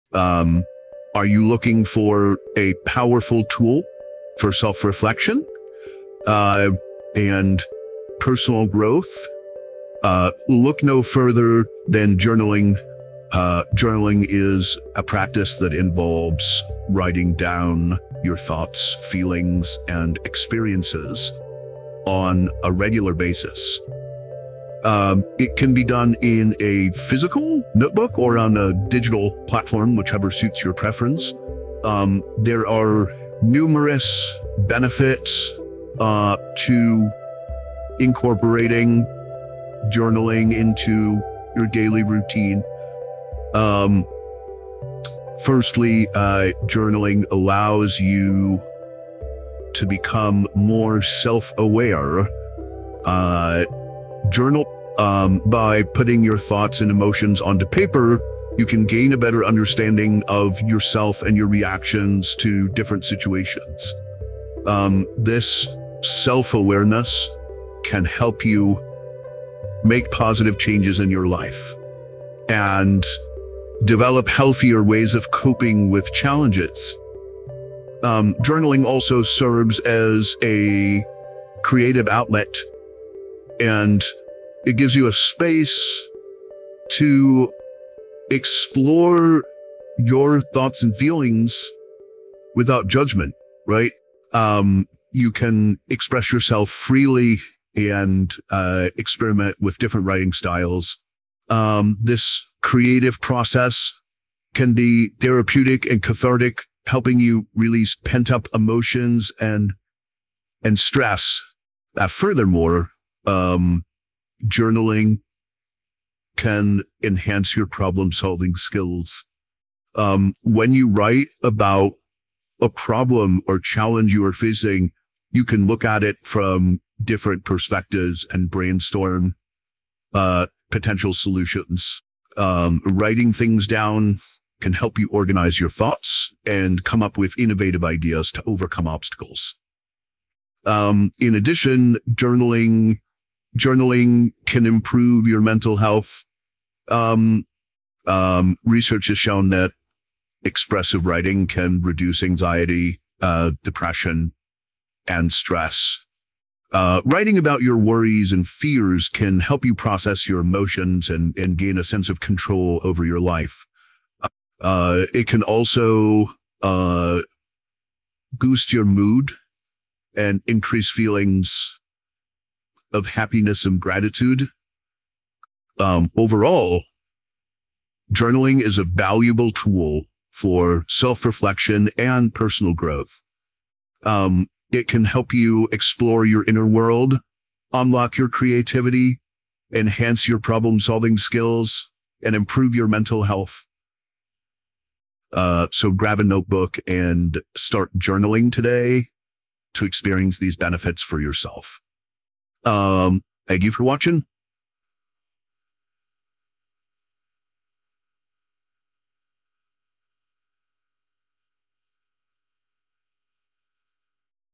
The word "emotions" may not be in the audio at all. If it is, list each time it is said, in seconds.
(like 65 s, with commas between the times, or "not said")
56 s, 108 s, 160 s.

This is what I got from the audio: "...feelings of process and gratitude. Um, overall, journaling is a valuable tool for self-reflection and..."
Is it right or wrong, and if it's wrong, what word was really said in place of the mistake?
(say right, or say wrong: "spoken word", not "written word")
wrong: "happiness", not "process".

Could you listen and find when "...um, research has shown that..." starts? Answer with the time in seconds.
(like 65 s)
148 s.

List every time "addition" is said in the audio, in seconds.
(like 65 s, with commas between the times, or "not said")
141 s.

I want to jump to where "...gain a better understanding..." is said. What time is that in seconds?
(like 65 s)
58 s.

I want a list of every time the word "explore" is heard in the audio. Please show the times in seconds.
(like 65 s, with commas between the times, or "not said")
88 s, 185 s.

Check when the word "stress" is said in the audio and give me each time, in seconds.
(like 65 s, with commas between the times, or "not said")
110 s, 155 s.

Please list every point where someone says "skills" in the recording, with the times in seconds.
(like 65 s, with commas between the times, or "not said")
118 s, 191 s.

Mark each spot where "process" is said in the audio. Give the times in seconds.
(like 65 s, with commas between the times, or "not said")
103 s, 159 s.